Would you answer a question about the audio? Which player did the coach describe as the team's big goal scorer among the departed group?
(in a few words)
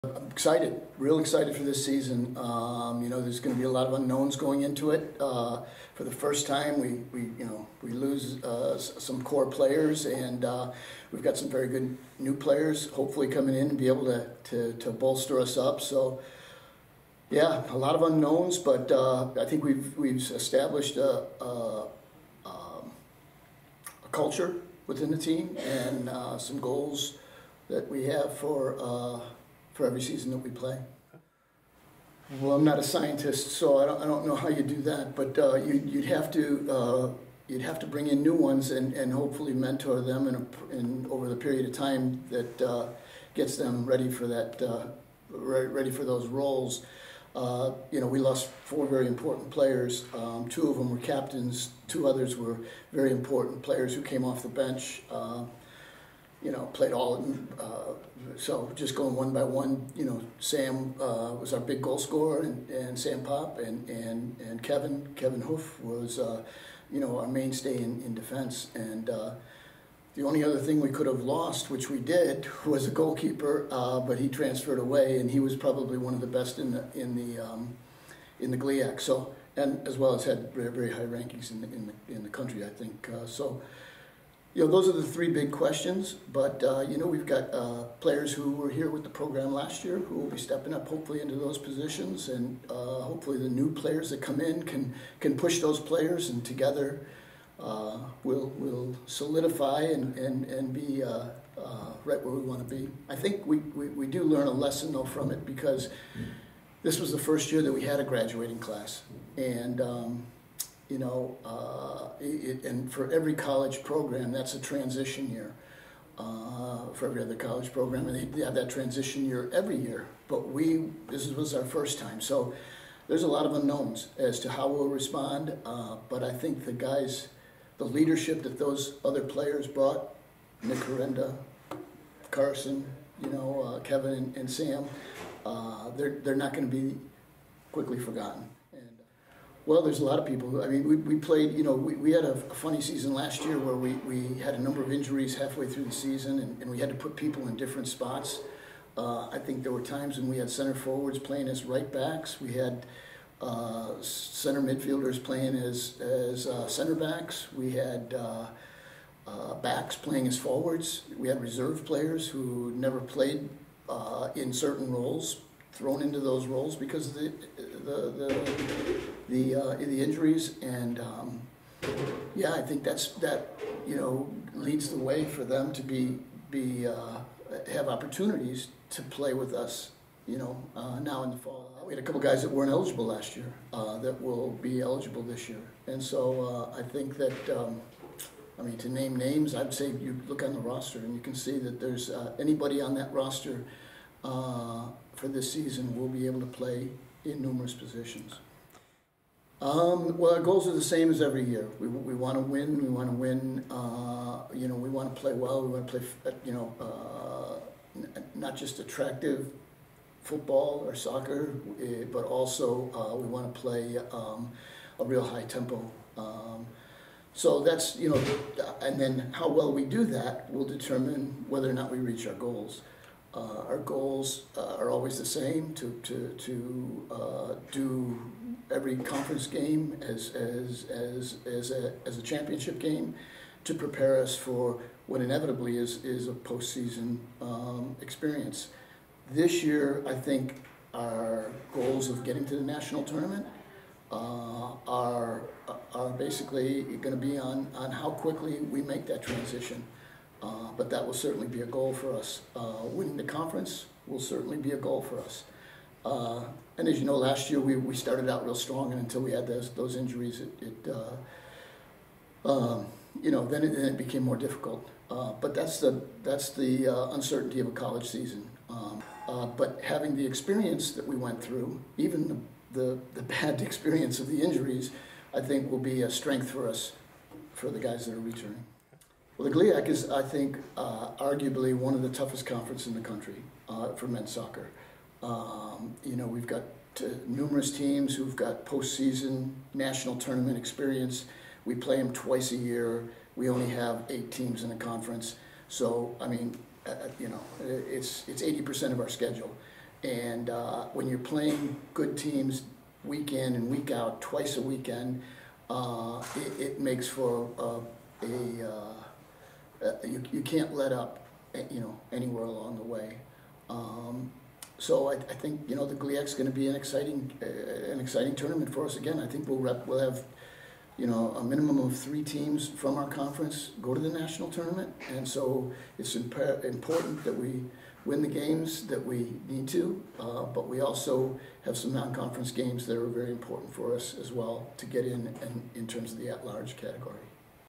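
Sam Pop.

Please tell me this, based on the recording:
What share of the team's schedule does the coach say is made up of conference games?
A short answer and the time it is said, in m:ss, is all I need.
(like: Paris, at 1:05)
80%, at 4:58.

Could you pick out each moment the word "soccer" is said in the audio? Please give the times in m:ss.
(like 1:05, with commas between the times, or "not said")
3:30, 4:44.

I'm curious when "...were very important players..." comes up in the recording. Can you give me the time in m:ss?
0:52.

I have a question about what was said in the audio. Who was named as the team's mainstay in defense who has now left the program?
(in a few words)
Kevin Hoof.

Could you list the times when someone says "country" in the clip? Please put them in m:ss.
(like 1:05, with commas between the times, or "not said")
1:22, 4:43.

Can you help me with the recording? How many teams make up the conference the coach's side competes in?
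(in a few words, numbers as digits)
8.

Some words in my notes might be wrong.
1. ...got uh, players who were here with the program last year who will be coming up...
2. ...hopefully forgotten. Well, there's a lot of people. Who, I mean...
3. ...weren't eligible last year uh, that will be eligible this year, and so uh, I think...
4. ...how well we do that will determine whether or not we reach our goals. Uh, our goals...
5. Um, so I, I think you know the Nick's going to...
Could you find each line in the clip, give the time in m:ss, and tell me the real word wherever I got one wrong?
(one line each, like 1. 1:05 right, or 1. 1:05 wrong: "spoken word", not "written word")
1. 1:27 wrong: "stepping", not "coming"
2. 2:17 wrong: "quickly", not "hopefully"
3. 3:02 right
4. 3:39 right
5. 5:13 wrong: "GLIAC", not "Nick".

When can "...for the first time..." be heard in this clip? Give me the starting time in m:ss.
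0:05.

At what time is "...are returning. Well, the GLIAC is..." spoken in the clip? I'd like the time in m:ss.
4:38.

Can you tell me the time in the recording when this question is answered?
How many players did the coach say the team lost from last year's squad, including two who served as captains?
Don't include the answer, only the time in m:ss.
0:48.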